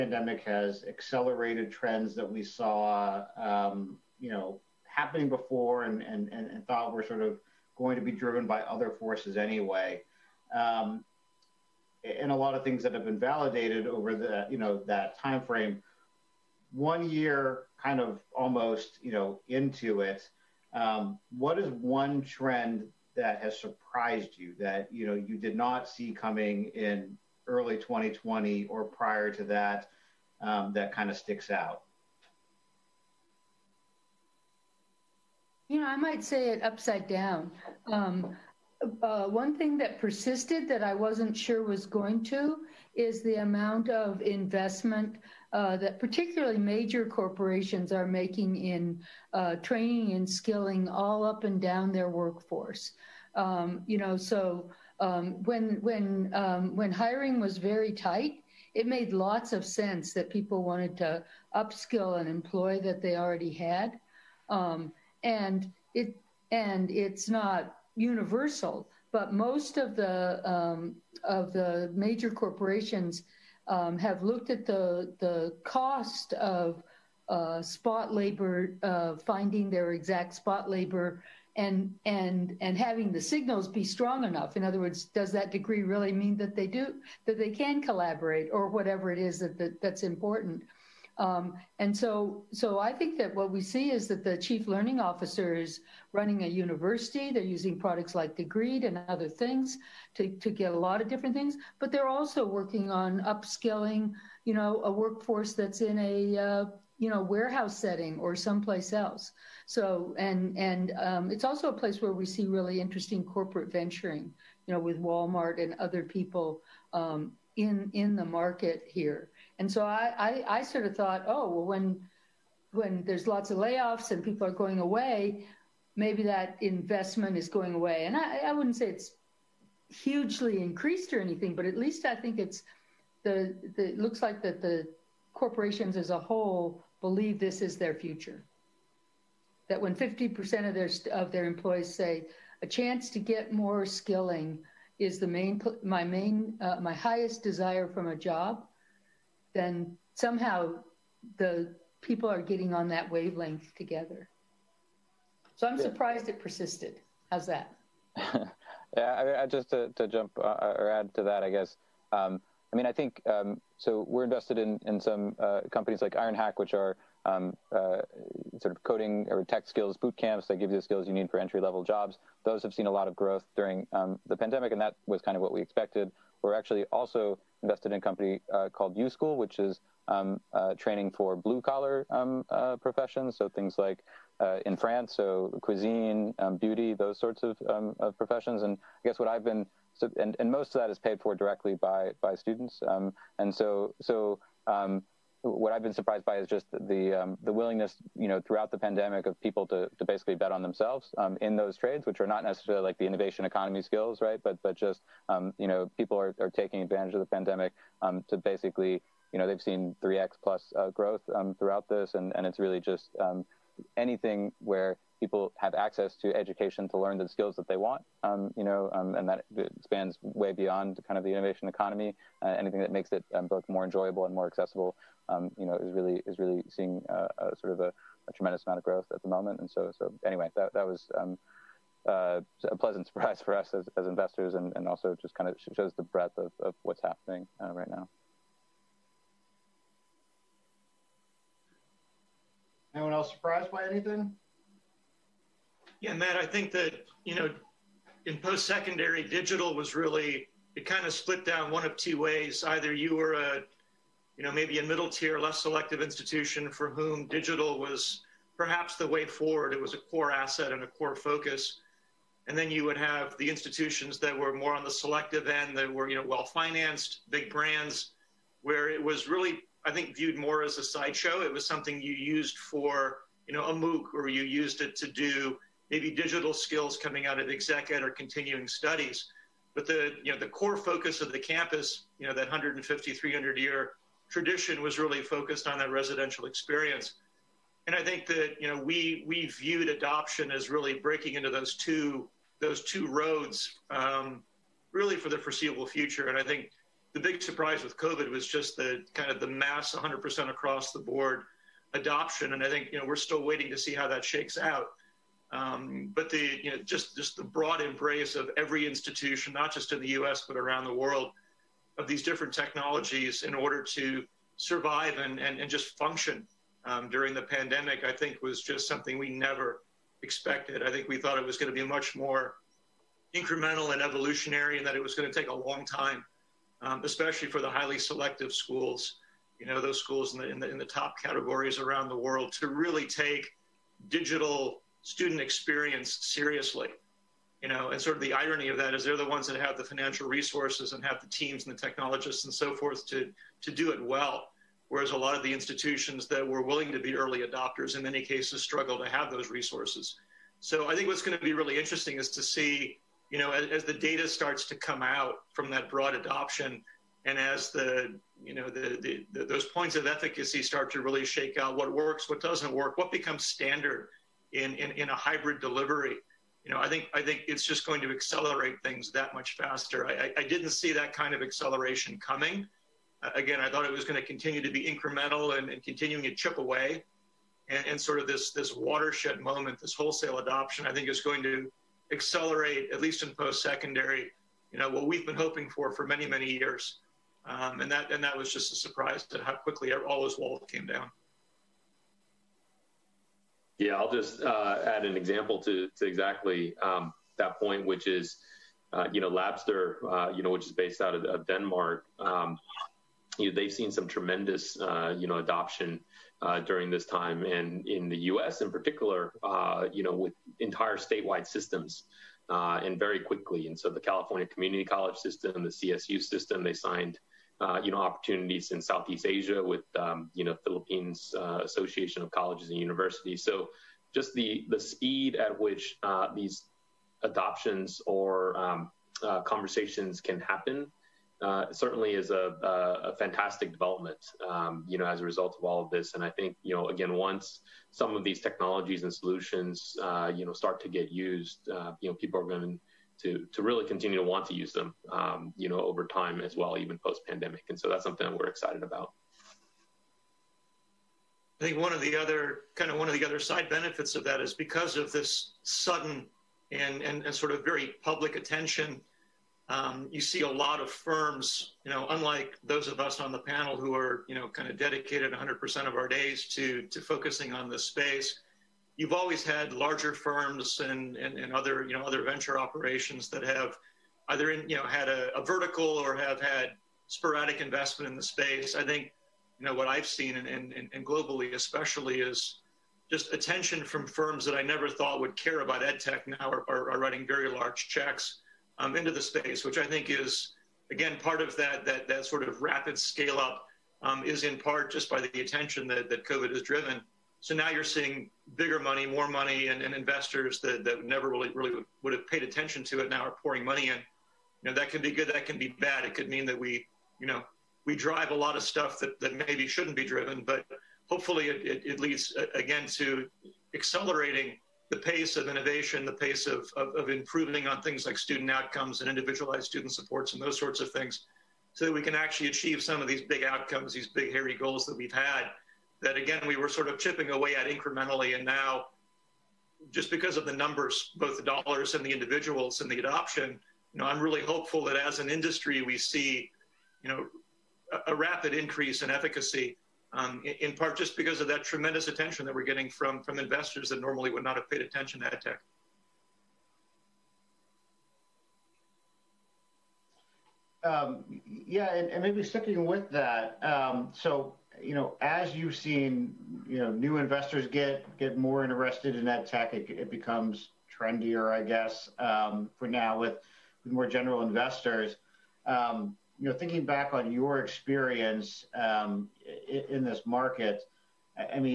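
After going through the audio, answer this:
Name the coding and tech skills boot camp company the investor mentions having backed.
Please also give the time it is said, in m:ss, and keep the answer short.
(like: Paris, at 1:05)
Ironhack, at 2:46.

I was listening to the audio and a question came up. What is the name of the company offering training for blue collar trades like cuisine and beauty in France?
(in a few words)
U School.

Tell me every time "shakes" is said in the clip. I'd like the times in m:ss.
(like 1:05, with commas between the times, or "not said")
5:04, 6:01.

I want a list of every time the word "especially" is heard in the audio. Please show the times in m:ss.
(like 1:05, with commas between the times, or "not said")
5:27, 8:01.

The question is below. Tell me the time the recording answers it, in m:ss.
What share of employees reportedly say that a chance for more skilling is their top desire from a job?
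2:19.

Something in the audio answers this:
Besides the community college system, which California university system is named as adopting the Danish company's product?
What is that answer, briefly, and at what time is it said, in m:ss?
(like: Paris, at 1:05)
CSU system, at 6:55.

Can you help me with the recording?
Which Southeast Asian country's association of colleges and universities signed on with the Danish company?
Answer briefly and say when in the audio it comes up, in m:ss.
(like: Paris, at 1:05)
Philippines, at 7:00.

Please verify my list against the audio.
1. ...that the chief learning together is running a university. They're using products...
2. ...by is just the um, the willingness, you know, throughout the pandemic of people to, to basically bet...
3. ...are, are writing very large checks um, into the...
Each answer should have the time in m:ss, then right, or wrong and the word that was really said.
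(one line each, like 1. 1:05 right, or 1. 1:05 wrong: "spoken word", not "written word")
1. 1:34 wrong: "officer", not "together"
2. 3:16 right
3. 8:06 right.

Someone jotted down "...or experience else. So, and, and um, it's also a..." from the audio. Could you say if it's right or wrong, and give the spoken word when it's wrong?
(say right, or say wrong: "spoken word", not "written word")
wrong: "someplace", not "experience".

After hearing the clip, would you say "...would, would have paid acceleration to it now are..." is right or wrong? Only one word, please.
wrong.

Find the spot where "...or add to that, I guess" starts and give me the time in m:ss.
2:40.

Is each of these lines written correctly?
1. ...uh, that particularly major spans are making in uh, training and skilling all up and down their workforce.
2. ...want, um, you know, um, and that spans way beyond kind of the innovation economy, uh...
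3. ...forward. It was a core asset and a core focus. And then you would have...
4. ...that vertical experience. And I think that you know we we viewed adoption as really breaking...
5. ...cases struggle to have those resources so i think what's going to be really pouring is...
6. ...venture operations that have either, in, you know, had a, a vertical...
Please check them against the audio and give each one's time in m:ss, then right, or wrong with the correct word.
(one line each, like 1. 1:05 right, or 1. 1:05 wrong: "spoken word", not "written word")
1. 0:45 wrong: "corporations", not "spans"
2. 3:37 right
3. 4:19 right
4. 4:45 wrong: "residential", not "vertical"
5. 5:48 wrong: "interesting", not "pouring"
6. 7:52 right.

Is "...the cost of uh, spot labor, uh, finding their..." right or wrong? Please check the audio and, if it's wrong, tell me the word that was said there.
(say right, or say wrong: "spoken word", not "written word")
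right.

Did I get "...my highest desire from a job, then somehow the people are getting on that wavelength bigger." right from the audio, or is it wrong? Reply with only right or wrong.
wrong.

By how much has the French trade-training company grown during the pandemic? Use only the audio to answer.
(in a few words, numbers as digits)
3x plus.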